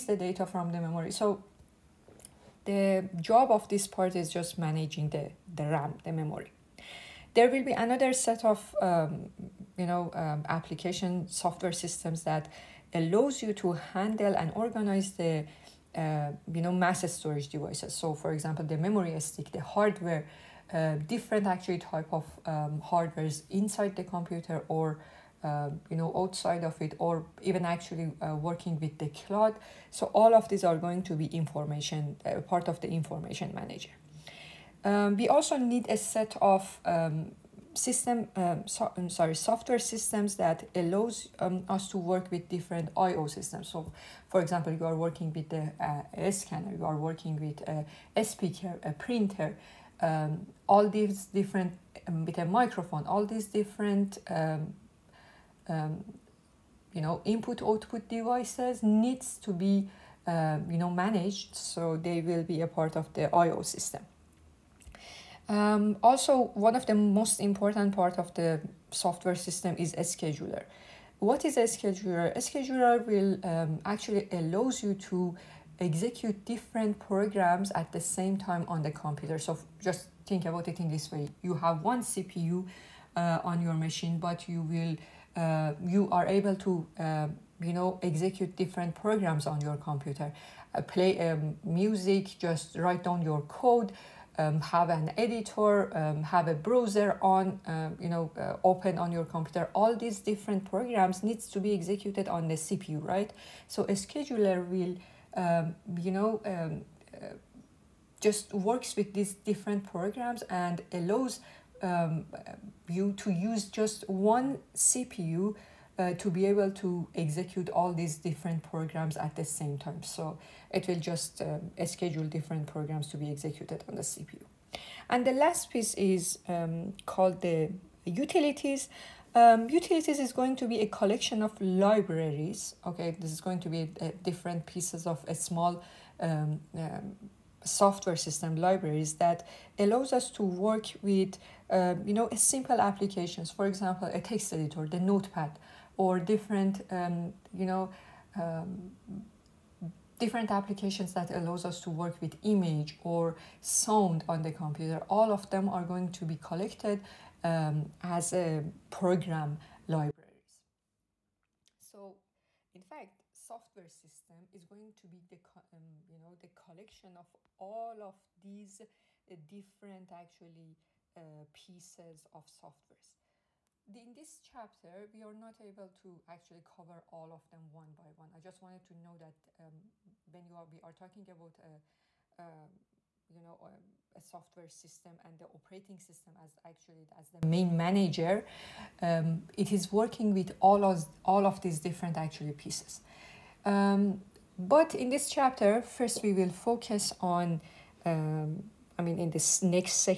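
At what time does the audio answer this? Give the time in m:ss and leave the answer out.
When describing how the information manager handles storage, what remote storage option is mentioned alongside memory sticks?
0:28.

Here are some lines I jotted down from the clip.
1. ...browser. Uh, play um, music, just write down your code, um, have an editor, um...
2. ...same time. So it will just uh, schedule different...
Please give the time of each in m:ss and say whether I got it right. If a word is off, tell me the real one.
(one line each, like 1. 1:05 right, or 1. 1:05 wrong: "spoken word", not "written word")
1. 1:29 wrong: "computer", not "browser"
2. 1:59 right.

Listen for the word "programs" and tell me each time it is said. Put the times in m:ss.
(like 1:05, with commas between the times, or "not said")
1:16, 1:28, 1:40, 1:49, 1:58, 2:02, 2:38.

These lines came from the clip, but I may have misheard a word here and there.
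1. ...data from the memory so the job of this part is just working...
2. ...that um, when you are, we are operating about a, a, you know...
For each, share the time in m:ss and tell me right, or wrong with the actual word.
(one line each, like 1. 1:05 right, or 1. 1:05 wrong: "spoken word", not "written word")
1. 0:00 wrong: "managing", not "working"
2. 2:59 wrong: "talking", not "operating".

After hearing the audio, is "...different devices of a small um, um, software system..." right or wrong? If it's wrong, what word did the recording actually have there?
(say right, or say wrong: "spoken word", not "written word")
wrong: "pieces", not "devices".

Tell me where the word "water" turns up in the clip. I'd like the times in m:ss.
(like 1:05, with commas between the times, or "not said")
not said.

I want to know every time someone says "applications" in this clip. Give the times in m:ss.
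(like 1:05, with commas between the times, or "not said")
0:10, 2:22, 2:30.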